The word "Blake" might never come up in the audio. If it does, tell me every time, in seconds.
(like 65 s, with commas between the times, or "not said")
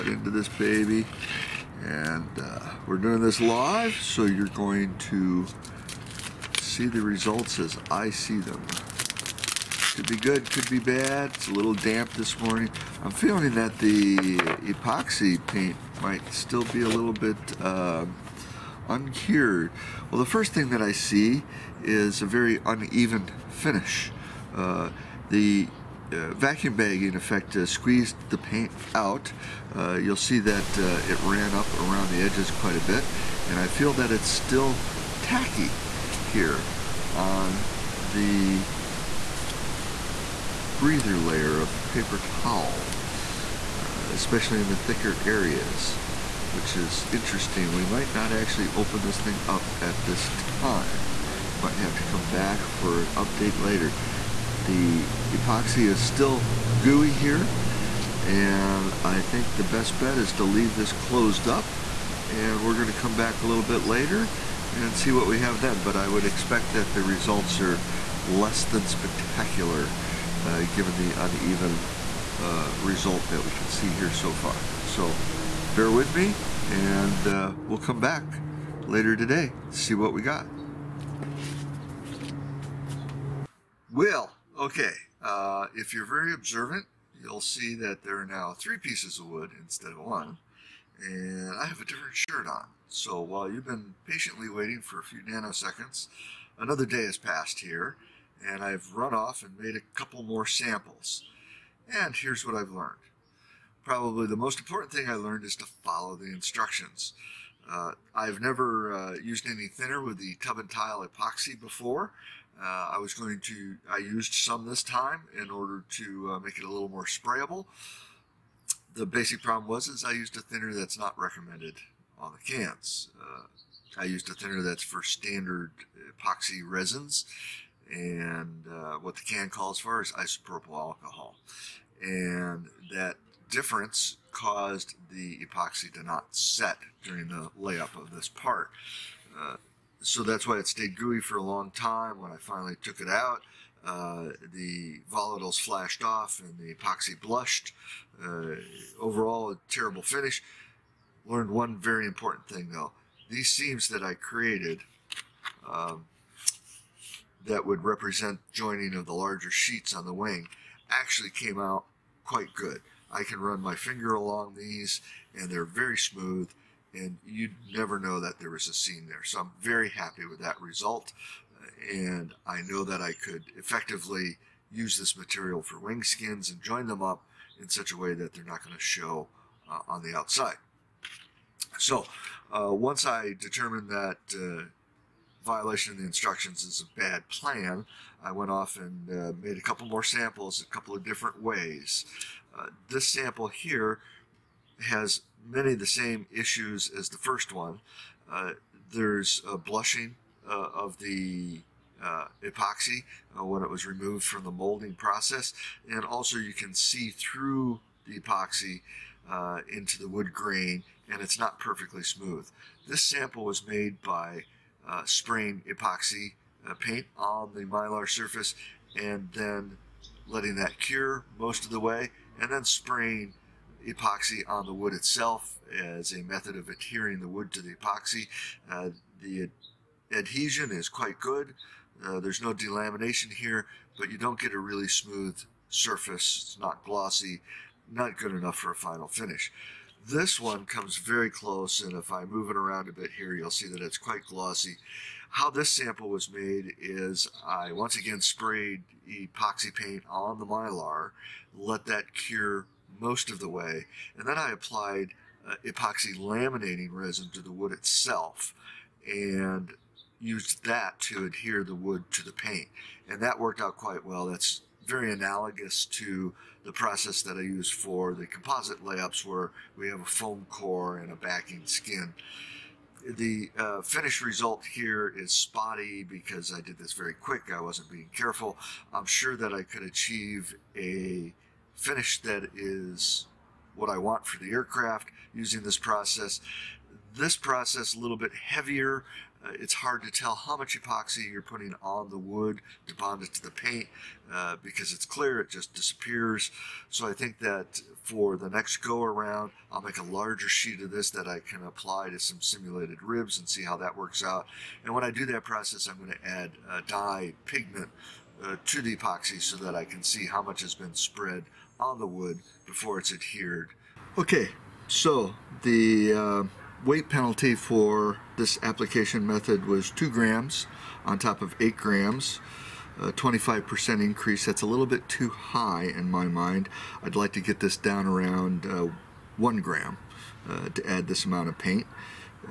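not said.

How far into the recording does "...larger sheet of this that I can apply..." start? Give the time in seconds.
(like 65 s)
300 s.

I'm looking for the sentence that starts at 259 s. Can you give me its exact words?
And used that to adhere the wood to the paint.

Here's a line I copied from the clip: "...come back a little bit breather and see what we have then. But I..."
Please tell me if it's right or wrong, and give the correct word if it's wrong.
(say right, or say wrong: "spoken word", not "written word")
wrong: "later", not "breather".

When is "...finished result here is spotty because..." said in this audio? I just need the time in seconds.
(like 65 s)
273 s.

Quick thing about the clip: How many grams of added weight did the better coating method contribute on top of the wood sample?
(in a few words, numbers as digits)
2 grams.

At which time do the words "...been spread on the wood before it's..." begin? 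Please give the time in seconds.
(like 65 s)
310 s.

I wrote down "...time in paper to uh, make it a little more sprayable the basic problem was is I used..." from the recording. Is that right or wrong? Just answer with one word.
wrong.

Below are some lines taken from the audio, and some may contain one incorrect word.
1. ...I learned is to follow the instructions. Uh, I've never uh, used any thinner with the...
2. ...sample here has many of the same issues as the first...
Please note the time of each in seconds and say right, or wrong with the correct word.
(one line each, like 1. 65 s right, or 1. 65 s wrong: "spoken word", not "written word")
1. 105 s right
2. 193 s right.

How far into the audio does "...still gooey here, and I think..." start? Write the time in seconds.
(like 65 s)
55 s.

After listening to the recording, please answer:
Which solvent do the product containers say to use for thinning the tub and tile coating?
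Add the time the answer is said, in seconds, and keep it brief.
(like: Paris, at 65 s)
isopropyl alcohol, at 130 s.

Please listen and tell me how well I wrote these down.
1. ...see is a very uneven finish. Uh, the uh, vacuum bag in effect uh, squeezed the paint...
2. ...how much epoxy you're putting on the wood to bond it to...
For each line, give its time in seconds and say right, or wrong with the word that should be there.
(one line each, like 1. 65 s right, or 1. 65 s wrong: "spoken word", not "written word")
1. 20 s right
2. 290 s right.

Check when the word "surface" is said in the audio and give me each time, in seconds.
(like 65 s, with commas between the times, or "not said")
218 s, 235 s.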